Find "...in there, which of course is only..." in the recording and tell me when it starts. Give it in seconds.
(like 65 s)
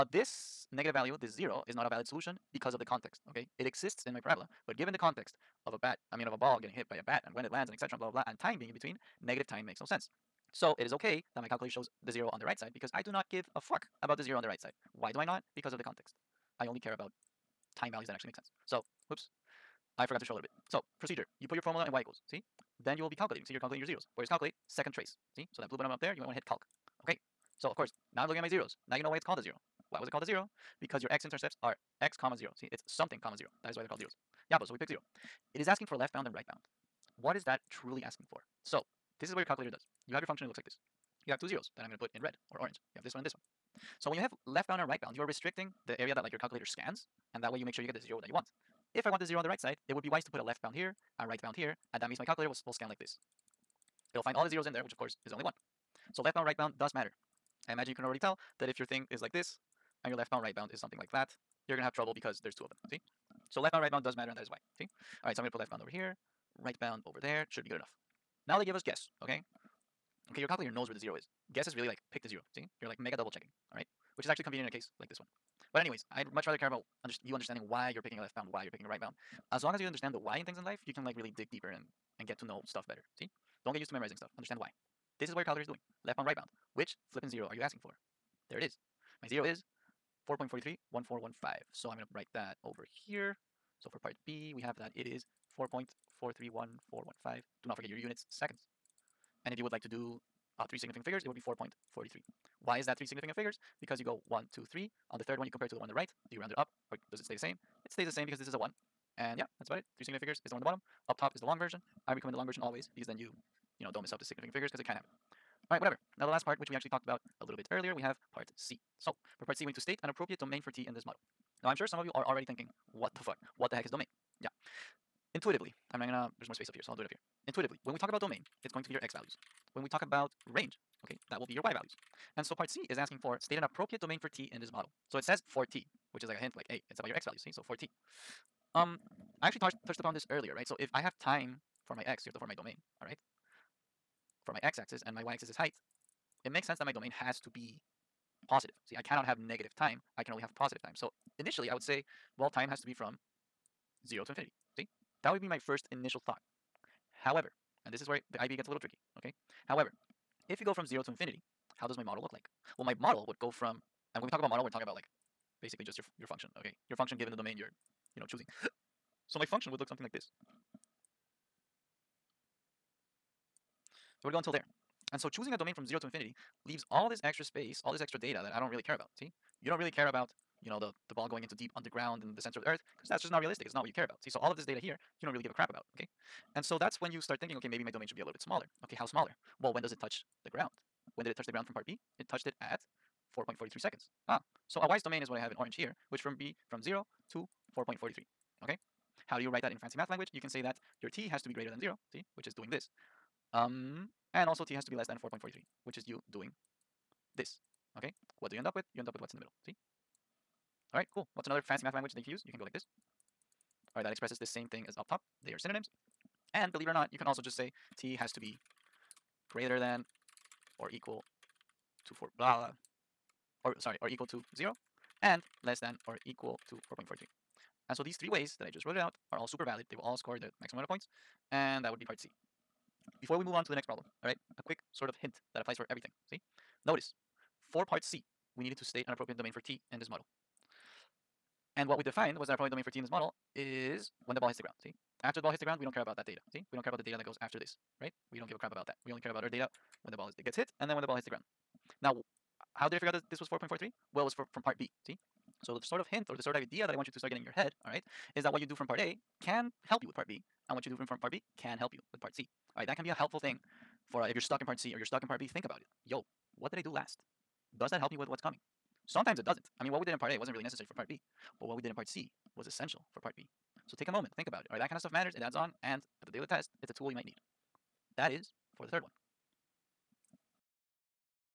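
54 s.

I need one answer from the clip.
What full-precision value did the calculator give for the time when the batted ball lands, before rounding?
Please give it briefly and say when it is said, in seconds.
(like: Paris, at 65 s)
4.431415, at 95 s.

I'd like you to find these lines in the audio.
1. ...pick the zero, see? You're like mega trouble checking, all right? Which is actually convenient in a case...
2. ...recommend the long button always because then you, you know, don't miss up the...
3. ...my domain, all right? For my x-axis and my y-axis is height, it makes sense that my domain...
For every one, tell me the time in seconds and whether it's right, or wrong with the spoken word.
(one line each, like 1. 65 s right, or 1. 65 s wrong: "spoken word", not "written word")
1. 72 s wrong: "double", not "trouble"
2. 112 s wrong: "version", not "button"
3. 142 s right.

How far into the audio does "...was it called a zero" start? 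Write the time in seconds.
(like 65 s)
29 s.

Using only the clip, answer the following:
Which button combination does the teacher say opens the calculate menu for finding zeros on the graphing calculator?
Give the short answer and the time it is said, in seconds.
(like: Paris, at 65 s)
second trace, at 24 s.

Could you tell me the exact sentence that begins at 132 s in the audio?
And so part C is asking for state an appropriate domain for T in this model.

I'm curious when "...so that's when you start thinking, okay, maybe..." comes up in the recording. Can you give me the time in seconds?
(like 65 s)
186 s.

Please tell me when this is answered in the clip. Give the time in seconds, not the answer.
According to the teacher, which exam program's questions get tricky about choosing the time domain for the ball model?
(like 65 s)
158 s.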